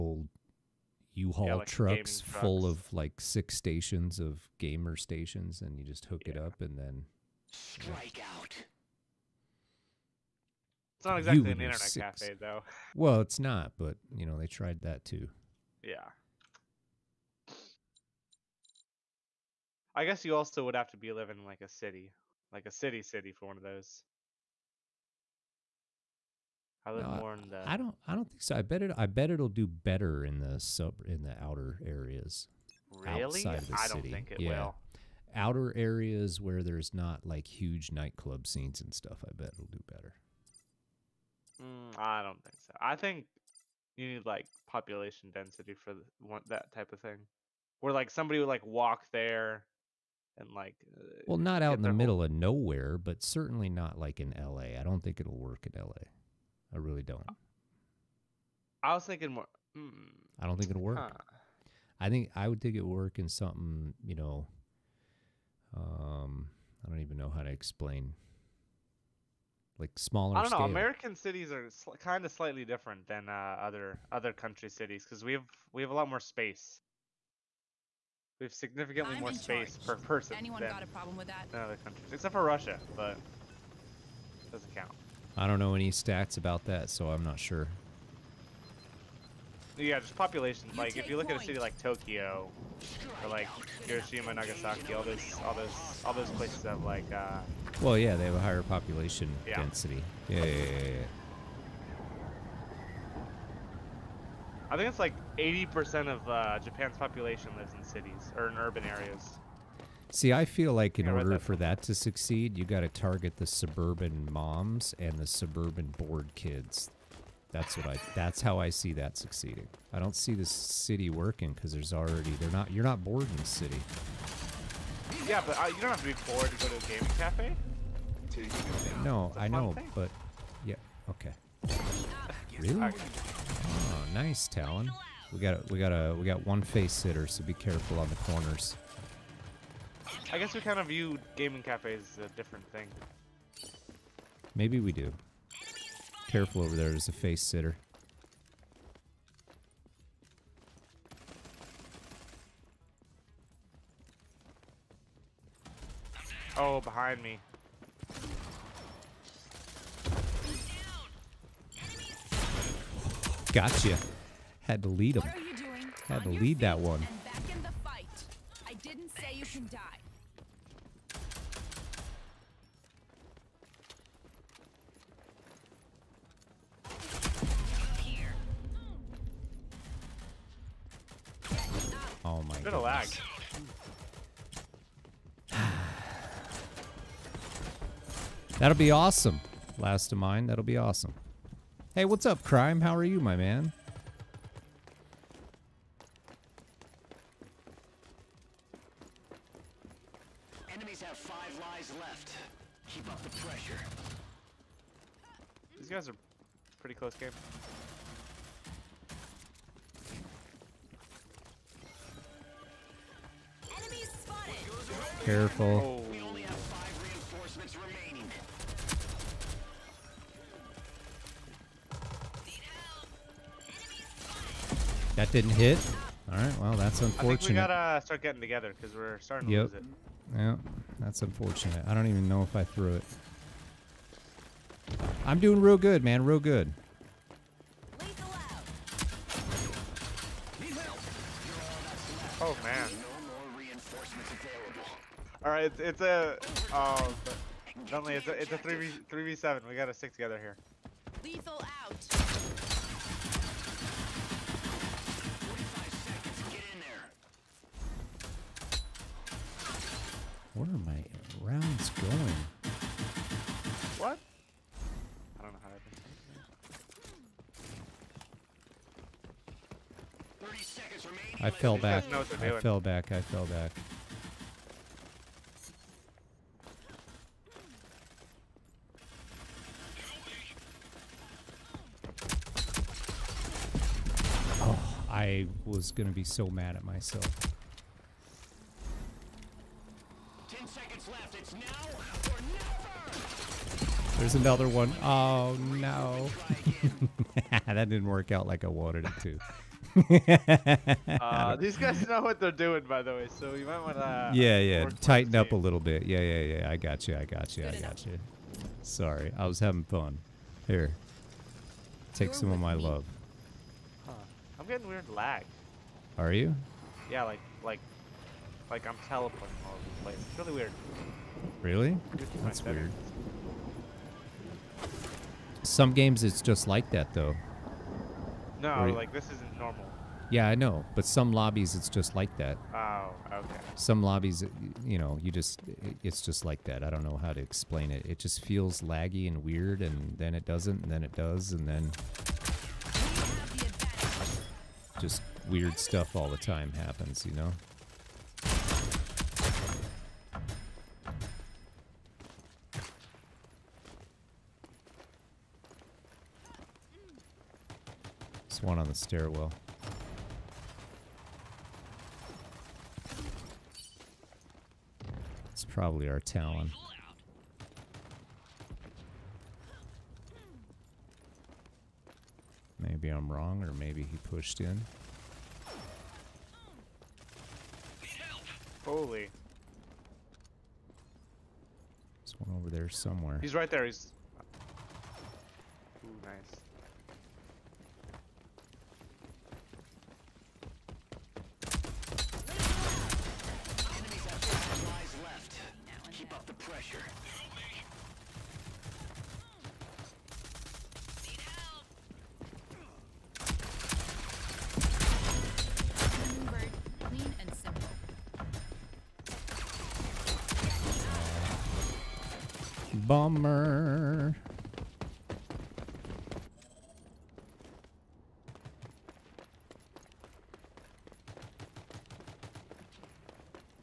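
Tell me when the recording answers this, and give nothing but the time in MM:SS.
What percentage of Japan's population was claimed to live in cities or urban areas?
01:45.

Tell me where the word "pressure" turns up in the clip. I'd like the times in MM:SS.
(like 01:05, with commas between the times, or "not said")
03:23.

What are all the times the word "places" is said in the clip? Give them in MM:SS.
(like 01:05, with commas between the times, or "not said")
01:36, 05:20.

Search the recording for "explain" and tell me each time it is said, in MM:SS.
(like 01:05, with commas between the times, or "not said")
01:07, 05:37.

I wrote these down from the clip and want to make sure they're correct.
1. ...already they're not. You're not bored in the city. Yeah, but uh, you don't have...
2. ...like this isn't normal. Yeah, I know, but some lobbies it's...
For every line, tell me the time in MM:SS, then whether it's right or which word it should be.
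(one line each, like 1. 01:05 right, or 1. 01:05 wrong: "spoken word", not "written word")
1. 02:01 right
2. 05:28 right.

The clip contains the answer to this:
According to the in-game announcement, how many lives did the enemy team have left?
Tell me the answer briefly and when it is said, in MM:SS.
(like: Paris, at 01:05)
5, at 03:21.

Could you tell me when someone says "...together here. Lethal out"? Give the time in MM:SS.
04:10.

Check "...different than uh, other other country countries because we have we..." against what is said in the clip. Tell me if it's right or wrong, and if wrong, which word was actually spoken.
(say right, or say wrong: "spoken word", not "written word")
wrong: "cities", not "countries".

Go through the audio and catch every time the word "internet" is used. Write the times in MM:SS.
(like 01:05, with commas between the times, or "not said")
00:11.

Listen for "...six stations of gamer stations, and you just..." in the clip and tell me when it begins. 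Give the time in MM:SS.
00:03.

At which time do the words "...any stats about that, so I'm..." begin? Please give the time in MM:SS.
01:25.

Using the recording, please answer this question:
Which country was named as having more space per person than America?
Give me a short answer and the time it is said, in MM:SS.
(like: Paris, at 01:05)
Russia, at 01:22.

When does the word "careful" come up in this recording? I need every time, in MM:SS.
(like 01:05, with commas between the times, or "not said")
02:17, 02:26, 03:35.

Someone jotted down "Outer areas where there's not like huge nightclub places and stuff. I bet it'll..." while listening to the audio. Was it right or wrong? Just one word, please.
wrong.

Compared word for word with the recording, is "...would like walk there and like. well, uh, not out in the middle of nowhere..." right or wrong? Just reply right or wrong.
right.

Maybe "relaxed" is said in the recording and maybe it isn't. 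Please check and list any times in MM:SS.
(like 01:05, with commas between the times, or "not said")
not said.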